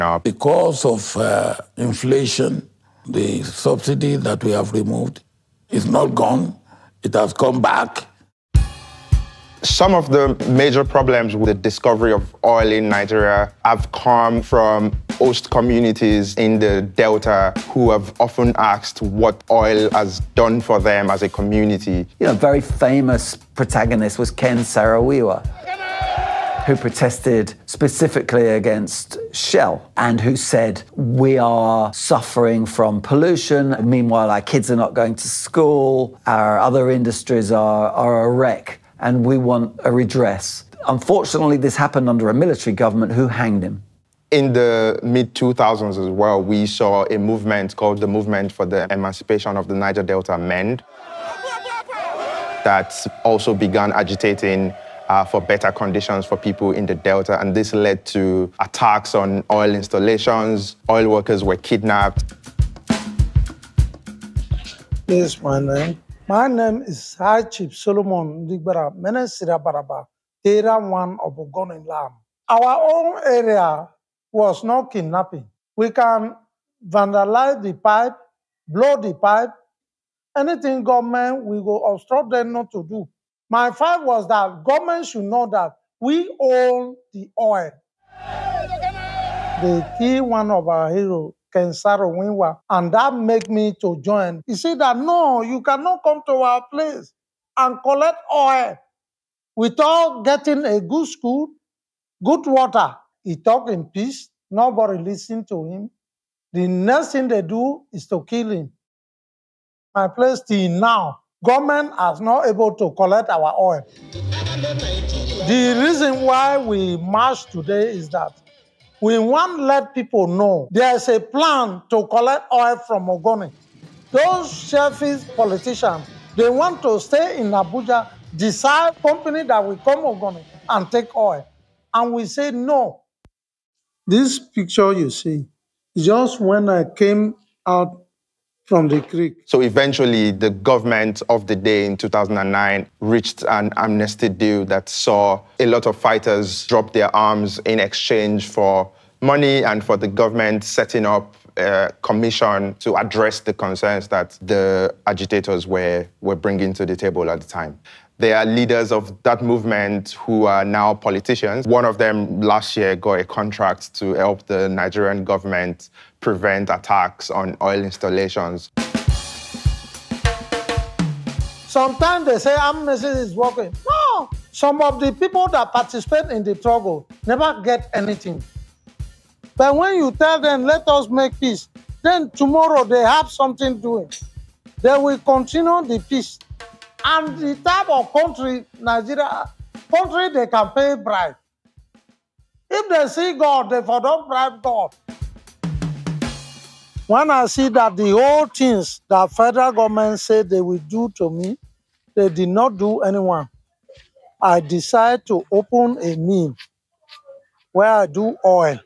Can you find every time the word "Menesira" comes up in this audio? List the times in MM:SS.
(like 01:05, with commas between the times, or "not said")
01:08.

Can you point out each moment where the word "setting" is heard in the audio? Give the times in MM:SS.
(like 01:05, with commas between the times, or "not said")
02:30.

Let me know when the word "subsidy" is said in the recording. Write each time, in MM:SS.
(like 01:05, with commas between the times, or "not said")
00:03.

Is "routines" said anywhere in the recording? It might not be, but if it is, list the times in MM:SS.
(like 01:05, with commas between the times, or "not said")
not said.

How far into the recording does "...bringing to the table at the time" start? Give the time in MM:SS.
02:36.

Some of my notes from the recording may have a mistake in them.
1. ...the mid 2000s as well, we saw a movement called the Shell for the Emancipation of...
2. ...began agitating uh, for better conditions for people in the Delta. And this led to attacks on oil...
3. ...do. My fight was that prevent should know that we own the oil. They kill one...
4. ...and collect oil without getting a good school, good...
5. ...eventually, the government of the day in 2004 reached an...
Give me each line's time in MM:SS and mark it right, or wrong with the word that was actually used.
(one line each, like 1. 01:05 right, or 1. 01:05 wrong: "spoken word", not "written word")
1. 00:44 wrong: "Movement", not "Shell"
2. 00:53 right
3. 01:22 wrong: "government", not "prevent"
4. 01:37 right
5. 02:19 wrong: "2009", not "2004".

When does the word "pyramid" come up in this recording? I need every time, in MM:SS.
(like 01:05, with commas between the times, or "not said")
not said.